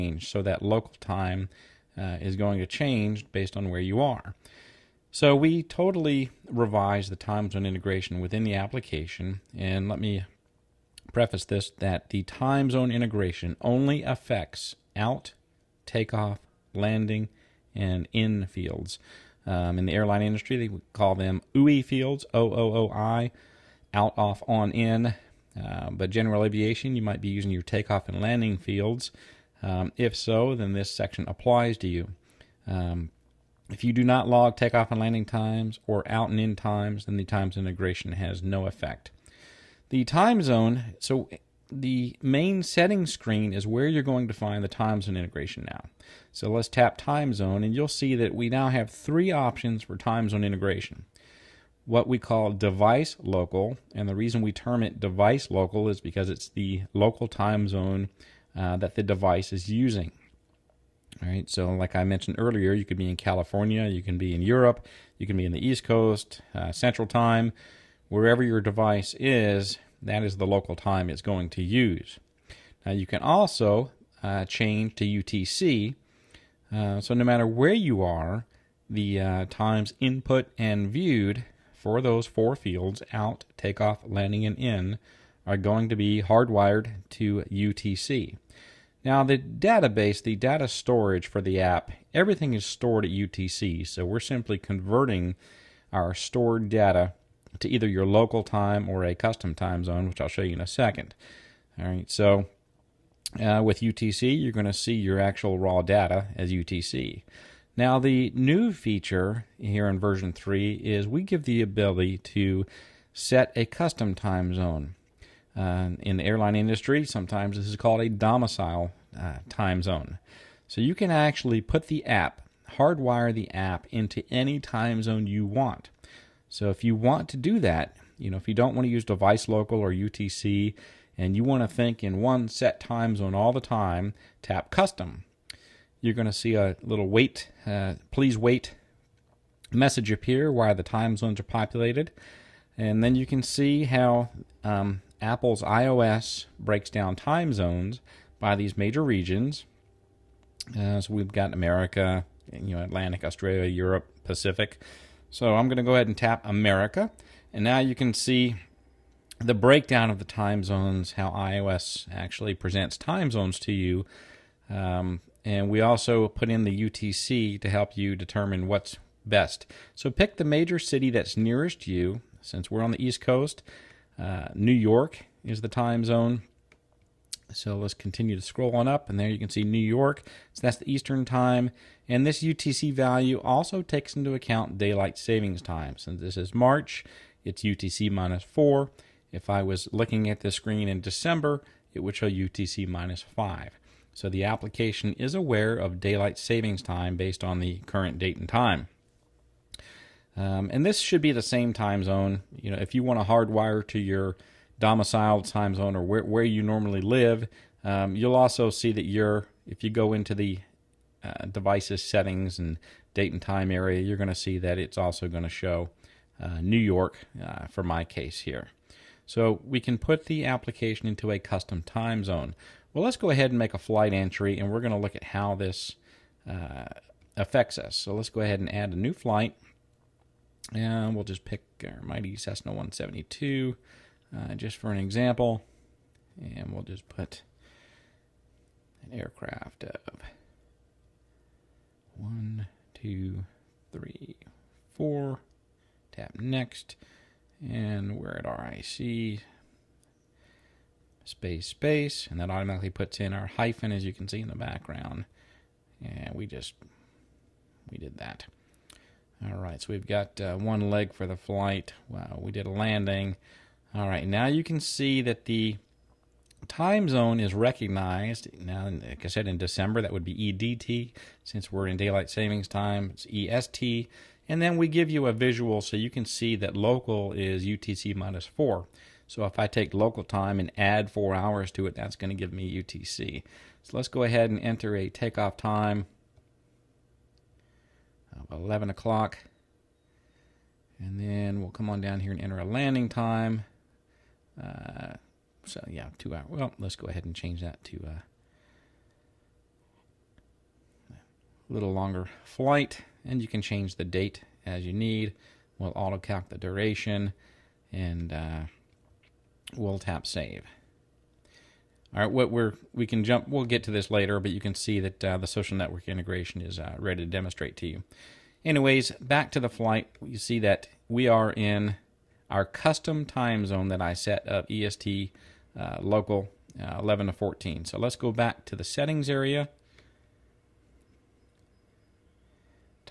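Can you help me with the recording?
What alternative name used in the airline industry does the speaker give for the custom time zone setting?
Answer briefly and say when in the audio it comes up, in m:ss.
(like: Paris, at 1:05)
domicile time zone, at 1:58.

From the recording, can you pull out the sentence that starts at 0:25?
Uh, but general aviation, you might be using your takeoff and landing fields.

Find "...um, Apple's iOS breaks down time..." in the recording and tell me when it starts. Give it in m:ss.
2:24.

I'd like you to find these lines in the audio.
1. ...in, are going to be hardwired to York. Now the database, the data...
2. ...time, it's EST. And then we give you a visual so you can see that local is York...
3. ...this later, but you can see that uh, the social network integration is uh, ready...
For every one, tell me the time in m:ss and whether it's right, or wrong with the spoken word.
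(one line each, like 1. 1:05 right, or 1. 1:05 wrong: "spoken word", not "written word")
1. 1:24 wrong: "UTC", not "York"
2. 4:32 wrong: "UTC", not "York"
3. 5:13 right.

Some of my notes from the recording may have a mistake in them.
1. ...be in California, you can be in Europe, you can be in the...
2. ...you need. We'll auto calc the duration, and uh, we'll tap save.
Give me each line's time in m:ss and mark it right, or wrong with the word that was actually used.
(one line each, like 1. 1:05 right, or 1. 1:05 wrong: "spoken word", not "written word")
1. 1:02 right
2. 5:04 right.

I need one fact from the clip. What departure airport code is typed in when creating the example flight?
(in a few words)
RIC.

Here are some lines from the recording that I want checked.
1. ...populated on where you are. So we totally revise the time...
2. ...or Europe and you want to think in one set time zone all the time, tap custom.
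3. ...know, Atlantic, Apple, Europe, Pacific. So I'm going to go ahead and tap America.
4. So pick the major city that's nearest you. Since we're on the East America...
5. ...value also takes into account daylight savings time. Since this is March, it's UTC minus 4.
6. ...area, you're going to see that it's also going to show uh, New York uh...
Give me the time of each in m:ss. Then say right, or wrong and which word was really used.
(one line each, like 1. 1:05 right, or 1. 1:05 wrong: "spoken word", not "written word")
1. 0:03 wrong: "based", not "populated"
2. 2:09 wrong: "UTC", not "Europe"
3. 2:32 wrong: "Australia", not "Apple"
4. 2:49 wrong: "Coast", not "America"
5. 3:02 right
6. 3:33 right.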